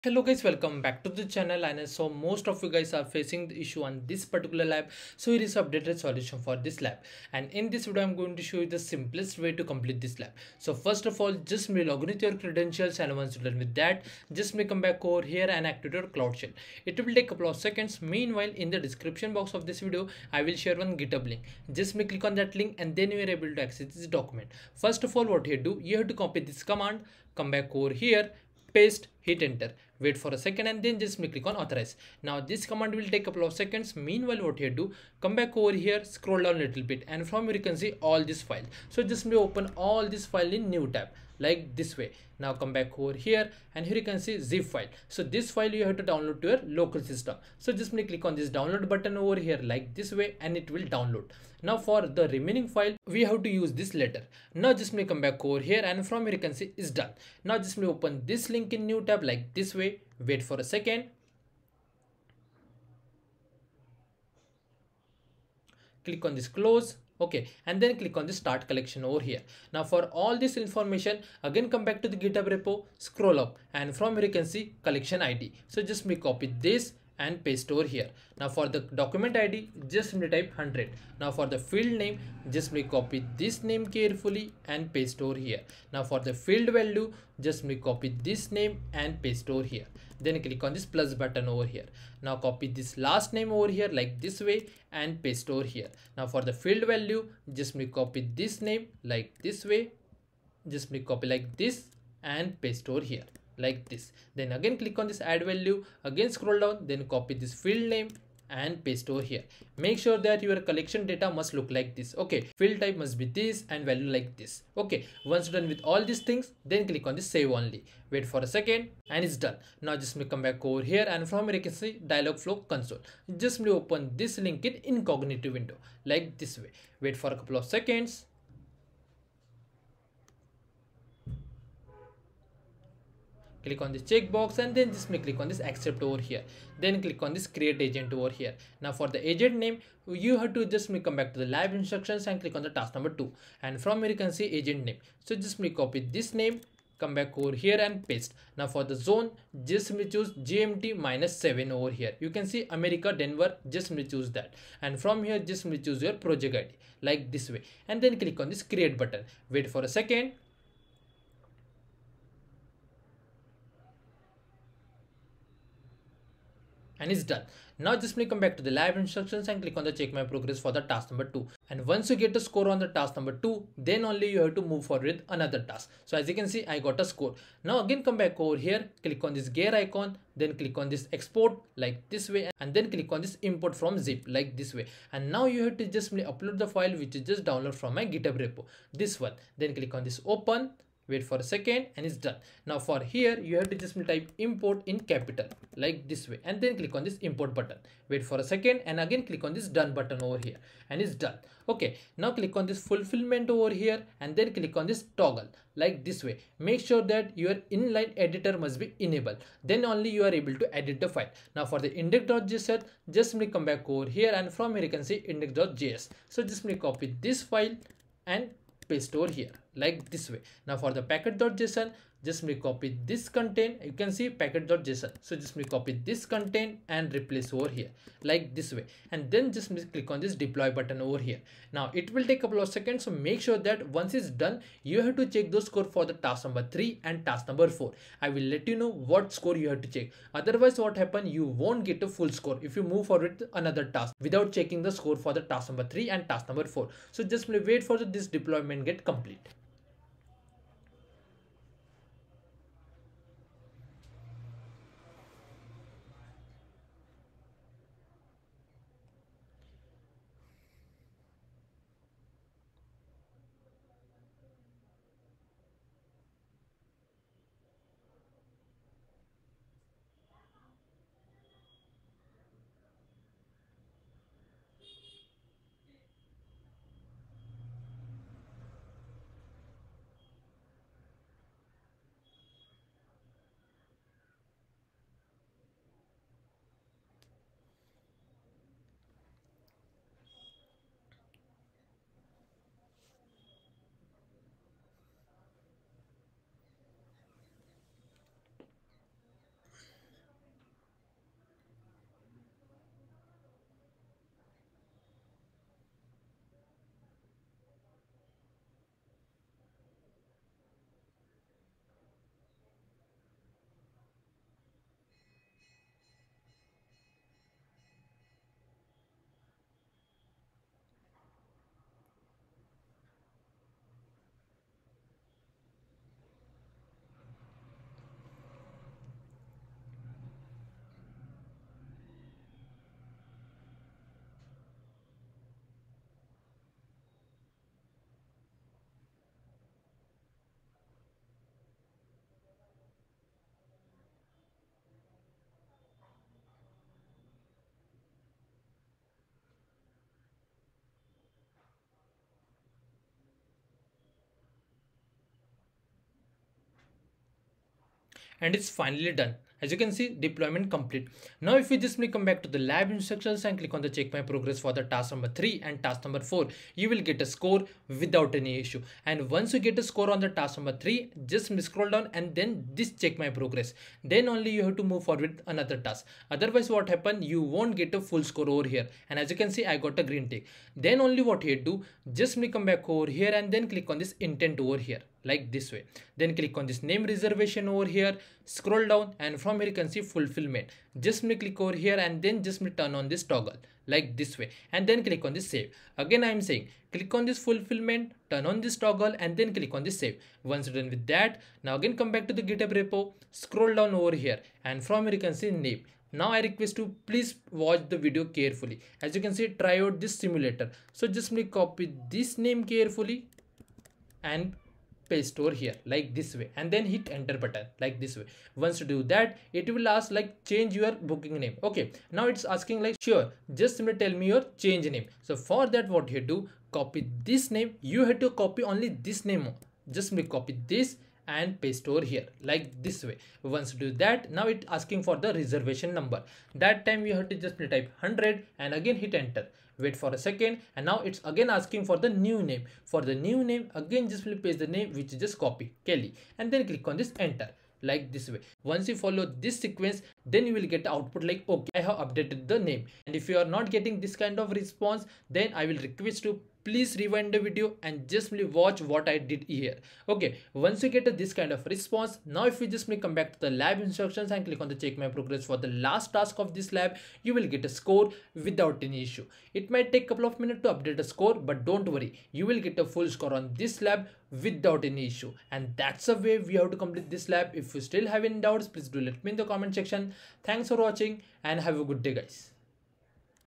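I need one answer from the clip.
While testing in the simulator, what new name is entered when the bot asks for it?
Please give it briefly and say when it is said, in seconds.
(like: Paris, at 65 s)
Kelly, at 445 s.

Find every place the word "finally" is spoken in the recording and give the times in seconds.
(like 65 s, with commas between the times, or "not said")
358 s.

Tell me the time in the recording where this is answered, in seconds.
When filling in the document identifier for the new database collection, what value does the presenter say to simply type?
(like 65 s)
79 s.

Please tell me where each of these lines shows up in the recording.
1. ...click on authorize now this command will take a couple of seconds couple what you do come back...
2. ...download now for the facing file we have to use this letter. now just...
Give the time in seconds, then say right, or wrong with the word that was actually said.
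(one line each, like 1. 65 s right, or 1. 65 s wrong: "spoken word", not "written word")
1. 31 s wrong: "meanwhile", not "couple"
2. 50 s wrong: "remaining", not "facing".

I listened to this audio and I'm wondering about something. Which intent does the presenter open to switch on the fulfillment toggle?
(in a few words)
name reservation.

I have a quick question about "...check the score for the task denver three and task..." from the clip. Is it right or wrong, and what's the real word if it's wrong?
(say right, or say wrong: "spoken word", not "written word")
wrong: "number", not "denver".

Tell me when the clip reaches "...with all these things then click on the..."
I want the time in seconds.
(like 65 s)
115 s.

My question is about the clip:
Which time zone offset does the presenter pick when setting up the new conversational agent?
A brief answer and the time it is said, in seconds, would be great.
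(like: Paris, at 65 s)
GMT minus 7, at 150 s.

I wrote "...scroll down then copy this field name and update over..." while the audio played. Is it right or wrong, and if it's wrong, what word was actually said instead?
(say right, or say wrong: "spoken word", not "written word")
wrong: "paste", not "update".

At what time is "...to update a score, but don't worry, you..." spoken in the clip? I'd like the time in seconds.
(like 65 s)
470 s.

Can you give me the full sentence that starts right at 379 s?
And as you can see, I got a green tick.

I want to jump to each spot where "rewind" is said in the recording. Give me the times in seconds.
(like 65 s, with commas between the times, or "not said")
456 s.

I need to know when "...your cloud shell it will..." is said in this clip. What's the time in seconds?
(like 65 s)
16 s.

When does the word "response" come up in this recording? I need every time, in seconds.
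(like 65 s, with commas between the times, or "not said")
454 s, 461 s.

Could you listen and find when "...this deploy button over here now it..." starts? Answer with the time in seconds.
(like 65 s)
230 s.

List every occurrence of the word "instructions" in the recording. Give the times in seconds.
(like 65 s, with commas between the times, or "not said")
141 s, 168 s, 362 s, 463 s.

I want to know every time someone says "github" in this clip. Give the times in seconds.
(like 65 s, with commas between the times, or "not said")
20 s, 72 s, 188 s, 402 s.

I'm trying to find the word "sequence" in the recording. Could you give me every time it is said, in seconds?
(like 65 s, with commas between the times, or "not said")
449 s.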